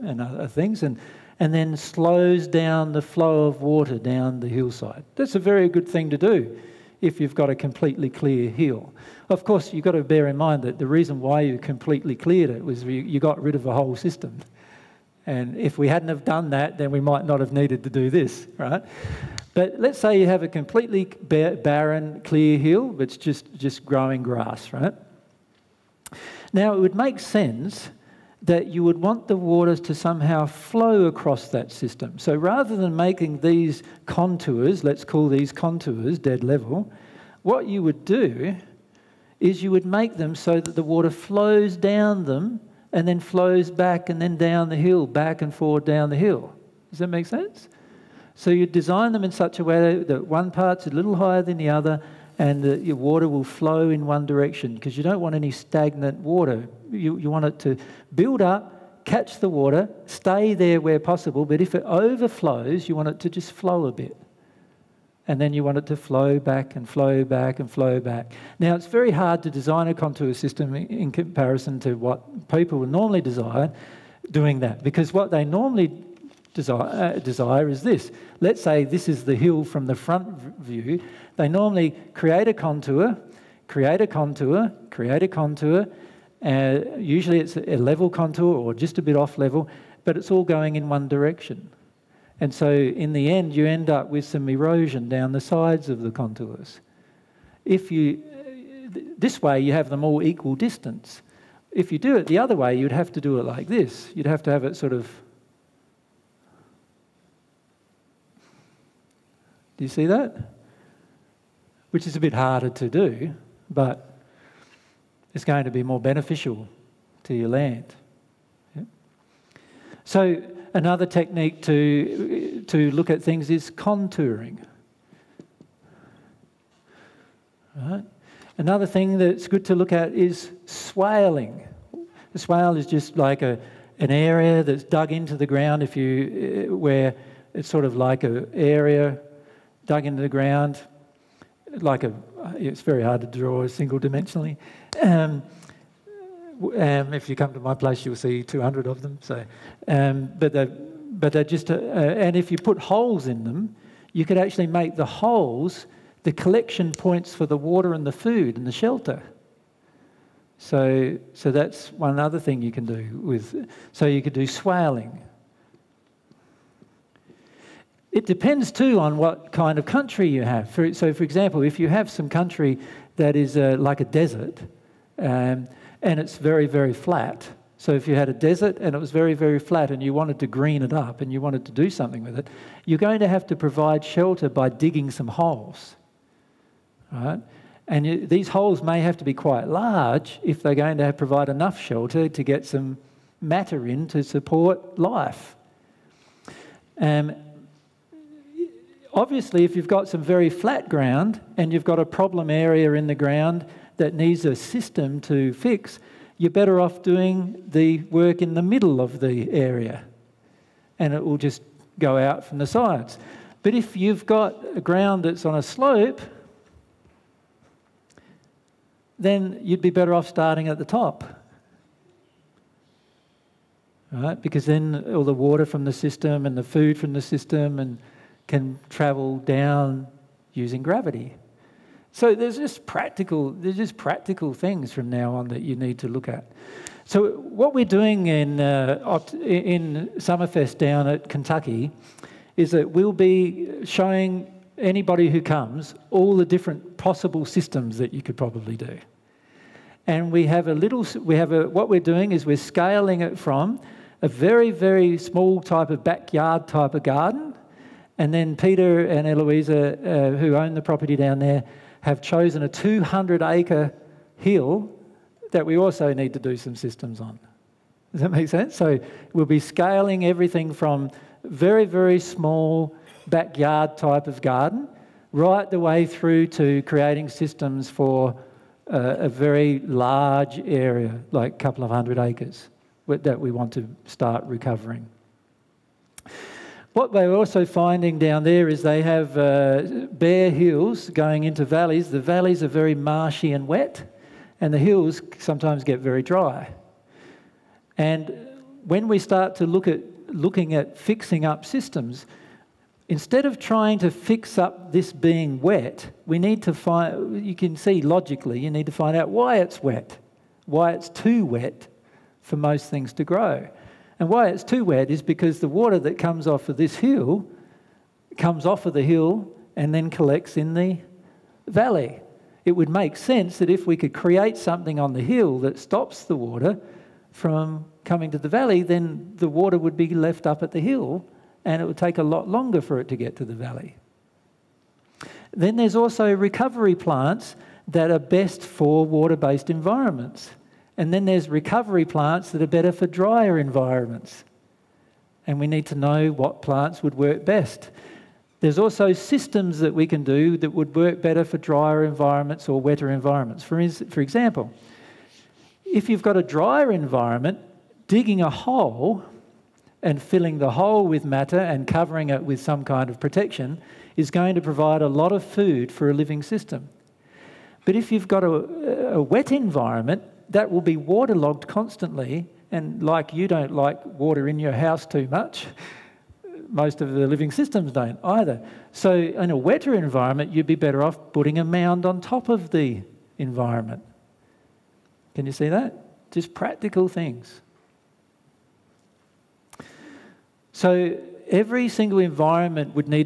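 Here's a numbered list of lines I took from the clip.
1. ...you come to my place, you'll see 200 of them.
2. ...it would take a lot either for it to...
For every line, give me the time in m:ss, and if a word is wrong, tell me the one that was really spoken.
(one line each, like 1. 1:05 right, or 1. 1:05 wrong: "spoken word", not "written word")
1. 2:27 right
2. 5:31 wrong: "longer", not "either".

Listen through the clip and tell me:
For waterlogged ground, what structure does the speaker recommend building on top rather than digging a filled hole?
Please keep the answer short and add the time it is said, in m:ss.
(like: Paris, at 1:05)
a mound, at 6:21.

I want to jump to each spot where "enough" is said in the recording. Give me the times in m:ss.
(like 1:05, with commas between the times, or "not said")
3:11.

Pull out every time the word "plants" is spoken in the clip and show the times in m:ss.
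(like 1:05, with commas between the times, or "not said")
5:36, 5:42, 5:46.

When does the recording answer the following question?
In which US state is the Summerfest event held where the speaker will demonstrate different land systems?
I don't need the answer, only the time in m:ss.
4:01.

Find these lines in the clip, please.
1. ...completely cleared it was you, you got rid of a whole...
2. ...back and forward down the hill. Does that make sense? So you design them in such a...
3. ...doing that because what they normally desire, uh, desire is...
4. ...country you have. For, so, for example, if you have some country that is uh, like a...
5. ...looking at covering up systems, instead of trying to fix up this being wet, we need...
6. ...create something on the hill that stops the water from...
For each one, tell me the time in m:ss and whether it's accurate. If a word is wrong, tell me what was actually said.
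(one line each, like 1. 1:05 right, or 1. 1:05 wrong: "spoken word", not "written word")
1. 0:11 right
2. 0:45 right
3. 1:14 right
4. 2:49 right
5. 5:00 wrong: "fixing", not "covering"
6. 5:24 right.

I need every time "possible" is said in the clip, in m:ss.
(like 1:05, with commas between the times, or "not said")
1:00, 4:07.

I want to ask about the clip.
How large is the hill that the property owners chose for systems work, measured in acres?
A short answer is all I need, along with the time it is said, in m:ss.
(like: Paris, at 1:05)
200 acres, at 4:22.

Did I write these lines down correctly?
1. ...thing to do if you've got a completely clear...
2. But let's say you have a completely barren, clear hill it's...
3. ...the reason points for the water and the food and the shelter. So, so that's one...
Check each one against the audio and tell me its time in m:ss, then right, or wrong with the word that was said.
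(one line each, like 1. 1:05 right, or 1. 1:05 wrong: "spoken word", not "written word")
1. 0:05 right
2. 0:19 right
3. 2:36 wrong: "collection", not "reason".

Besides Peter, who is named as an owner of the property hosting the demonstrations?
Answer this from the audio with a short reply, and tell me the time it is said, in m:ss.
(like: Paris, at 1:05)
Eloisa, at 4:19.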